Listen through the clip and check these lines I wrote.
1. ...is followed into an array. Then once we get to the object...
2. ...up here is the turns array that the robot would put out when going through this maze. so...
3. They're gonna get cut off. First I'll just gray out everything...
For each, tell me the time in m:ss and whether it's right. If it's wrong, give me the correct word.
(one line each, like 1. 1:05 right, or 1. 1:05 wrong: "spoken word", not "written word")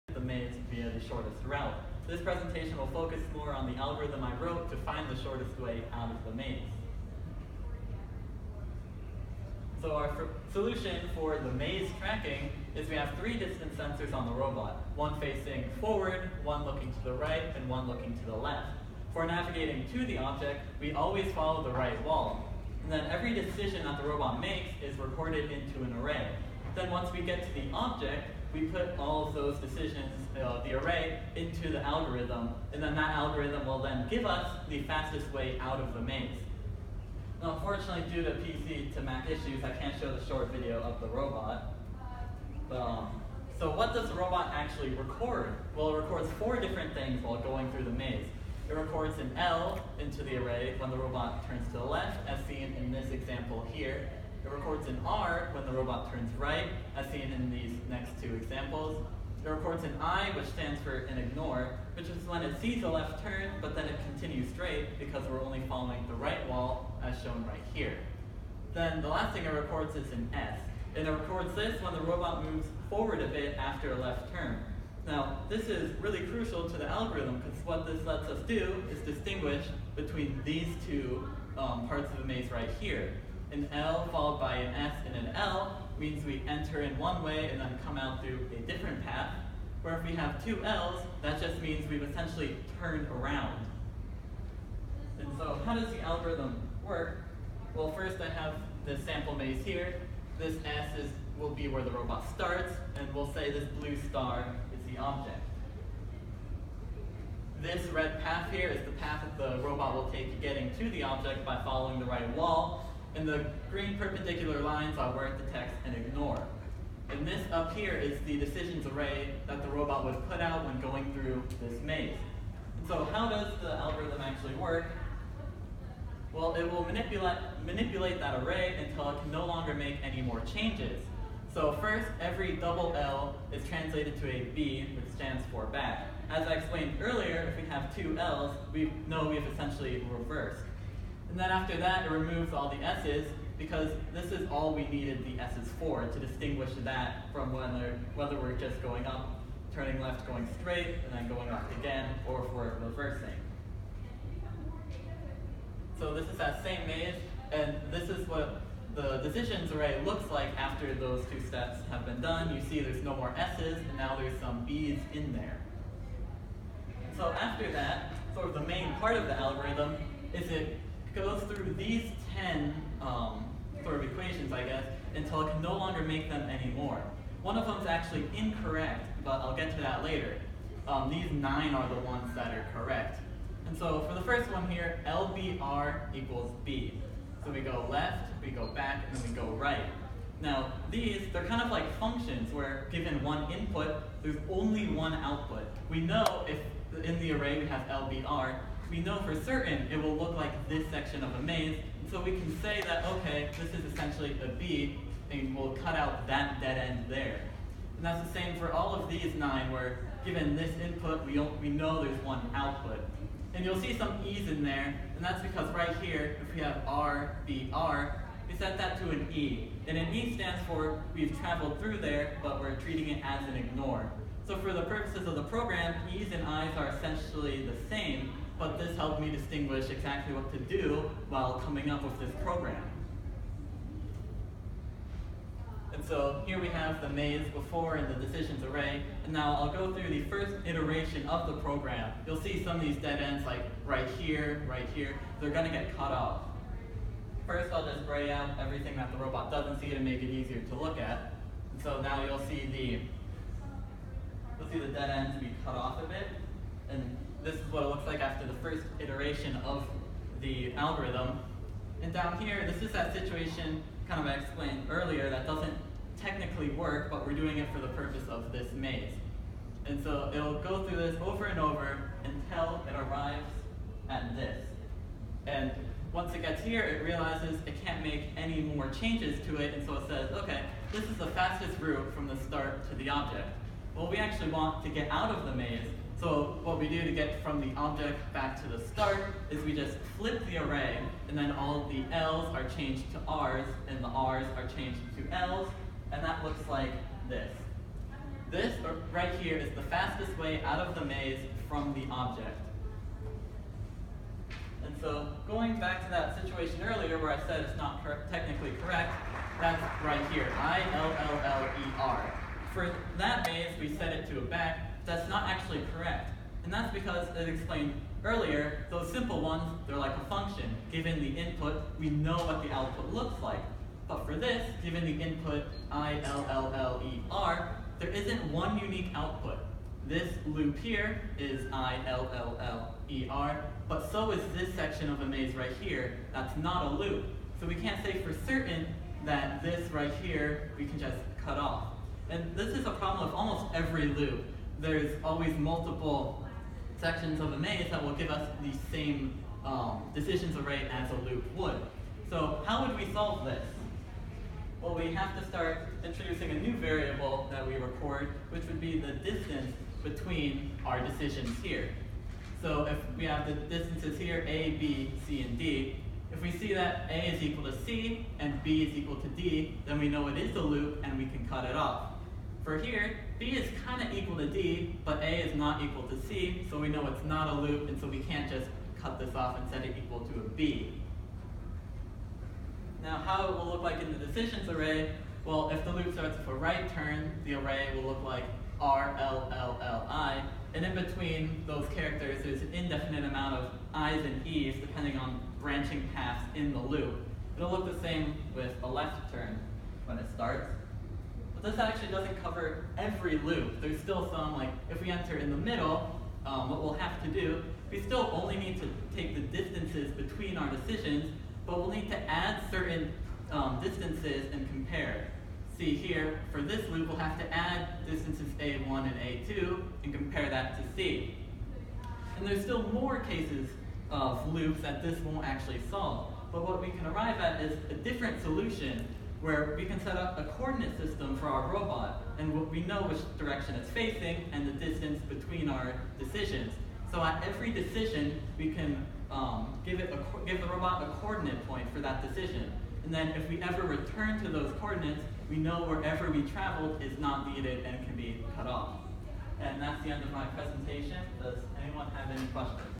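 1. 0:24 wrong: "recorded", not "followed"
2. 1:57 wrong: "decisions", not "turns"
3. 4:05 right.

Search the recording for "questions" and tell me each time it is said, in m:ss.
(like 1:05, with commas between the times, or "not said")
7:32.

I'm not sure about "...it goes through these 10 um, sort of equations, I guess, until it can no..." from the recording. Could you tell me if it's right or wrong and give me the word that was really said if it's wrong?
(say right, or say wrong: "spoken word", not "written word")
right.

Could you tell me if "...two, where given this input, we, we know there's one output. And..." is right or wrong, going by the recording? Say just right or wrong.
wrong.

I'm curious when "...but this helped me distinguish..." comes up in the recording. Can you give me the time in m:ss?
3:48.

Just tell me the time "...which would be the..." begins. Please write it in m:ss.
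5:58.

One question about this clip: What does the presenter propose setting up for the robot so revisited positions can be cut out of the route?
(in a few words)
A coordinate system.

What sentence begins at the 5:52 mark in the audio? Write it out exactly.
So how would we solve this?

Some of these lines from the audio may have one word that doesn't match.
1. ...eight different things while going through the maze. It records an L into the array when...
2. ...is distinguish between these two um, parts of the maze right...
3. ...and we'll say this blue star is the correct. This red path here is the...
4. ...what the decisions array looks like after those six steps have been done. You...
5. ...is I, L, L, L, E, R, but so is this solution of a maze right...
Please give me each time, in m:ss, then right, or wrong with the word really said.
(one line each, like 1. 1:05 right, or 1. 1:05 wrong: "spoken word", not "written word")
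1. 0:46 wrong: "four", not "eight"
2. 1:18 right
3. 1:42 wrong: "object", not "correct"
4. 2:38 wrong: "two", not "six"
5. 5:31 wrong: "section", not "solution".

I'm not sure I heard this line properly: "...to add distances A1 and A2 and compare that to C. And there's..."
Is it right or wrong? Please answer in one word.
right.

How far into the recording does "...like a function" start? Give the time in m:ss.
5:19.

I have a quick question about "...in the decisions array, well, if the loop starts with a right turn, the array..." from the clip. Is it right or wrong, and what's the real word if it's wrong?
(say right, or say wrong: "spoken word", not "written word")
right.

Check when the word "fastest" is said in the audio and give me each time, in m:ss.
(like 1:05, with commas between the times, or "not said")
0:34, 4:41, 4:59.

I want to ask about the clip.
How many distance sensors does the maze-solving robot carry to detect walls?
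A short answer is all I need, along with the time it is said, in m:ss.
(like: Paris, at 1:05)
3, at 0:13.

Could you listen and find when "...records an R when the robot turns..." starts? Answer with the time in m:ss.
0:54.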